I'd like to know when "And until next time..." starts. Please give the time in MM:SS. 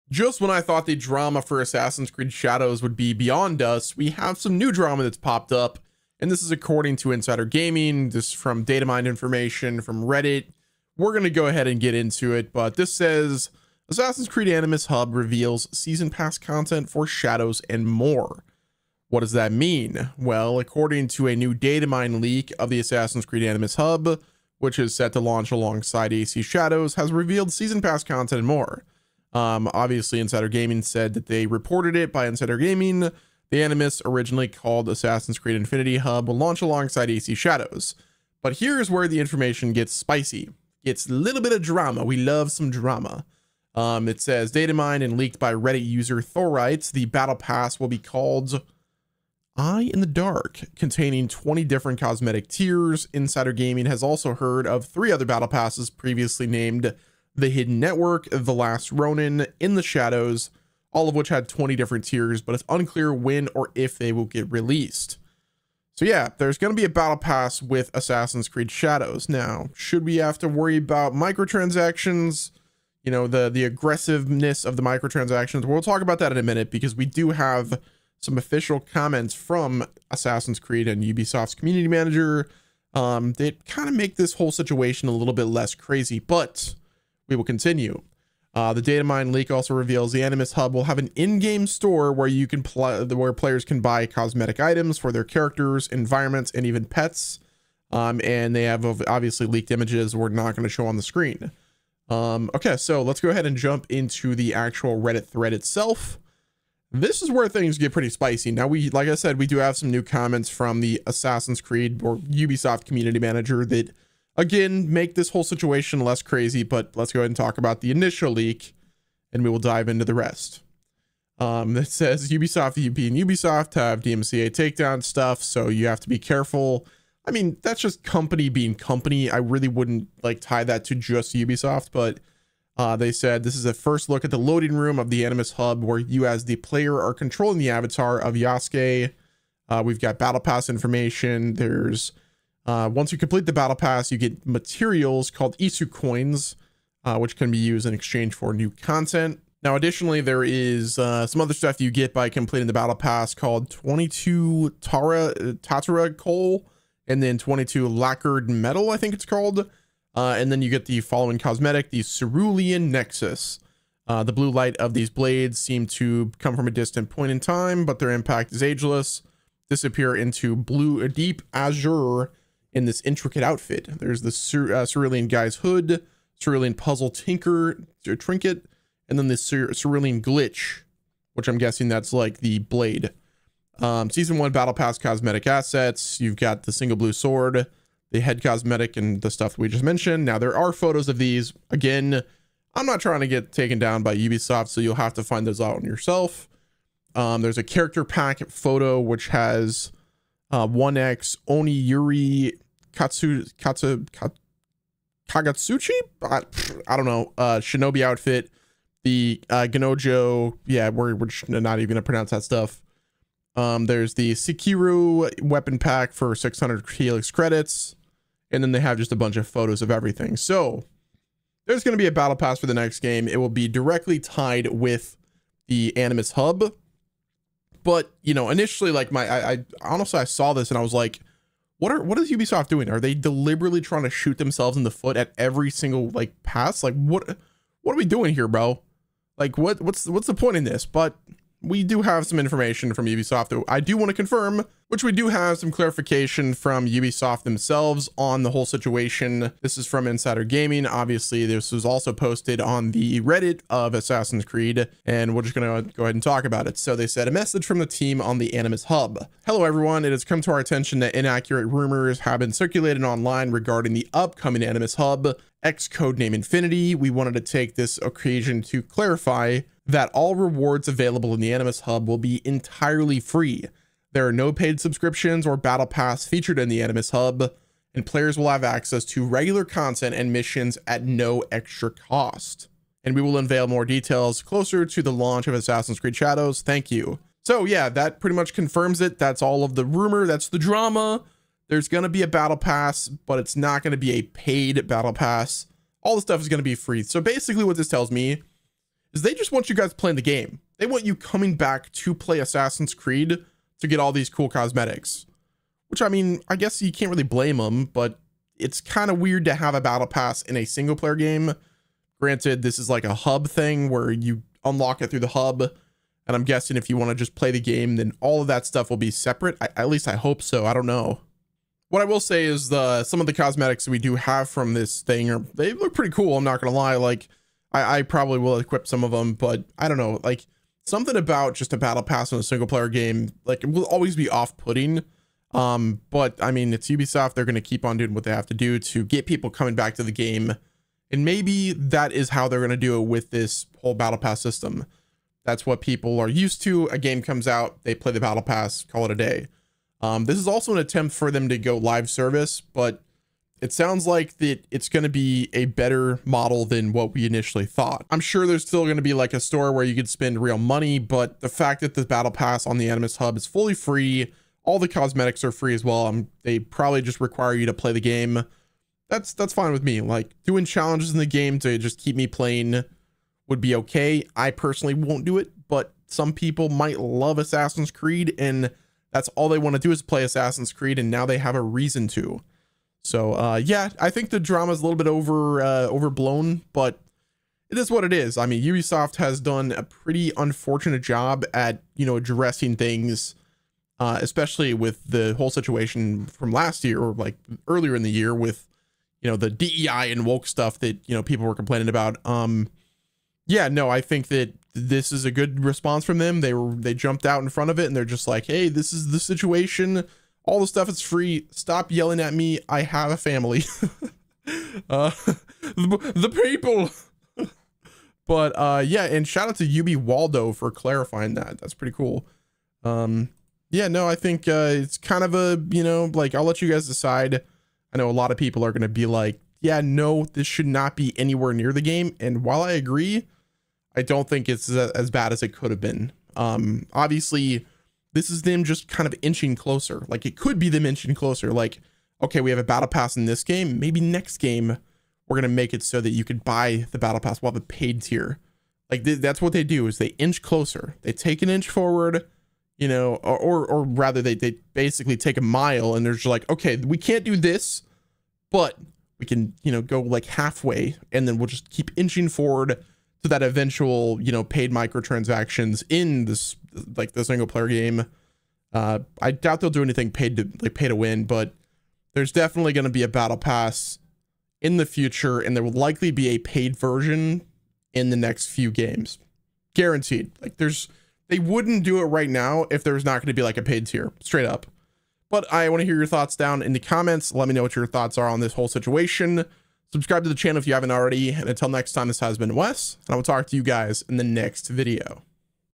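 08:11.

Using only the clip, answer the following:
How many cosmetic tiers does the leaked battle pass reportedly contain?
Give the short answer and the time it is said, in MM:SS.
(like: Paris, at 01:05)
20, at 00:51.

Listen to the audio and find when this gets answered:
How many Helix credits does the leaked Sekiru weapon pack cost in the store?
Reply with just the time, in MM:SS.
03:36.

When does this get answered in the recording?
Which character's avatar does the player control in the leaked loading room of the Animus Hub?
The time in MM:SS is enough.
02:18.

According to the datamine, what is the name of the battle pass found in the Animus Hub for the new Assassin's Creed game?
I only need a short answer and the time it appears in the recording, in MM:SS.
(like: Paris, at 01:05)
Eye in the Dark, at 00:49.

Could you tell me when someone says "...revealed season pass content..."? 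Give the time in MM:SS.
00:27.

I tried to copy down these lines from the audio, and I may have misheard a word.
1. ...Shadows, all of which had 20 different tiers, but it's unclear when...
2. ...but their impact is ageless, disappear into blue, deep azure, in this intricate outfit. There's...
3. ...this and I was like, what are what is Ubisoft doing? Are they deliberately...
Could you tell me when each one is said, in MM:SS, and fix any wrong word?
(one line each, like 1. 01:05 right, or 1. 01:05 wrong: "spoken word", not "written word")
1. 00:59 right
2. 02:47 right
3. 03:50 right.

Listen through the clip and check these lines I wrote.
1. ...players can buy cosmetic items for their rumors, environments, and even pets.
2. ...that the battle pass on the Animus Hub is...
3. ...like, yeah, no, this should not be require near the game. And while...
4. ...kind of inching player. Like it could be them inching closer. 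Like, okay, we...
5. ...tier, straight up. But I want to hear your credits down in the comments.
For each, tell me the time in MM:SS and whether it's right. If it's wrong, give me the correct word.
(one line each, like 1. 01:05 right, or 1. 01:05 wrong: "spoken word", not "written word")
1. 01:33 wrong: "characters", not "rumors"
2. 06:01 right
3. 07:09 wrong: "anywhere", not "require"
4. 07:18 wrong: "closer", not "player"
5. 08:03 wrong: "thoughts", not "credits".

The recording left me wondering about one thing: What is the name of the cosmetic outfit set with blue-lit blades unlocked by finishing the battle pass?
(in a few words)
Cerulean Nexus.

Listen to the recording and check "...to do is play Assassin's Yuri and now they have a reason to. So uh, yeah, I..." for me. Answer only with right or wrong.
wrong.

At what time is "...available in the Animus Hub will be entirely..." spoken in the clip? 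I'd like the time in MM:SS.
04:30.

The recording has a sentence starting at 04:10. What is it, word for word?
Obviously, this was also posted on the Reddit of Assassin's Creed, and we're just going to go ahead and talk about it.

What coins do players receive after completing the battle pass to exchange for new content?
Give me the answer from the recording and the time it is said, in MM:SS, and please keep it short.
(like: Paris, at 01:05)
Isu coins, at 02:25.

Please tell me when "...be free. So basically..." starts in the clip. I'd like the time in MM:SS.
04:56.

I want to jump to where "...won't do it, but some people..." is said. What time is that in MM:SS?
06:14.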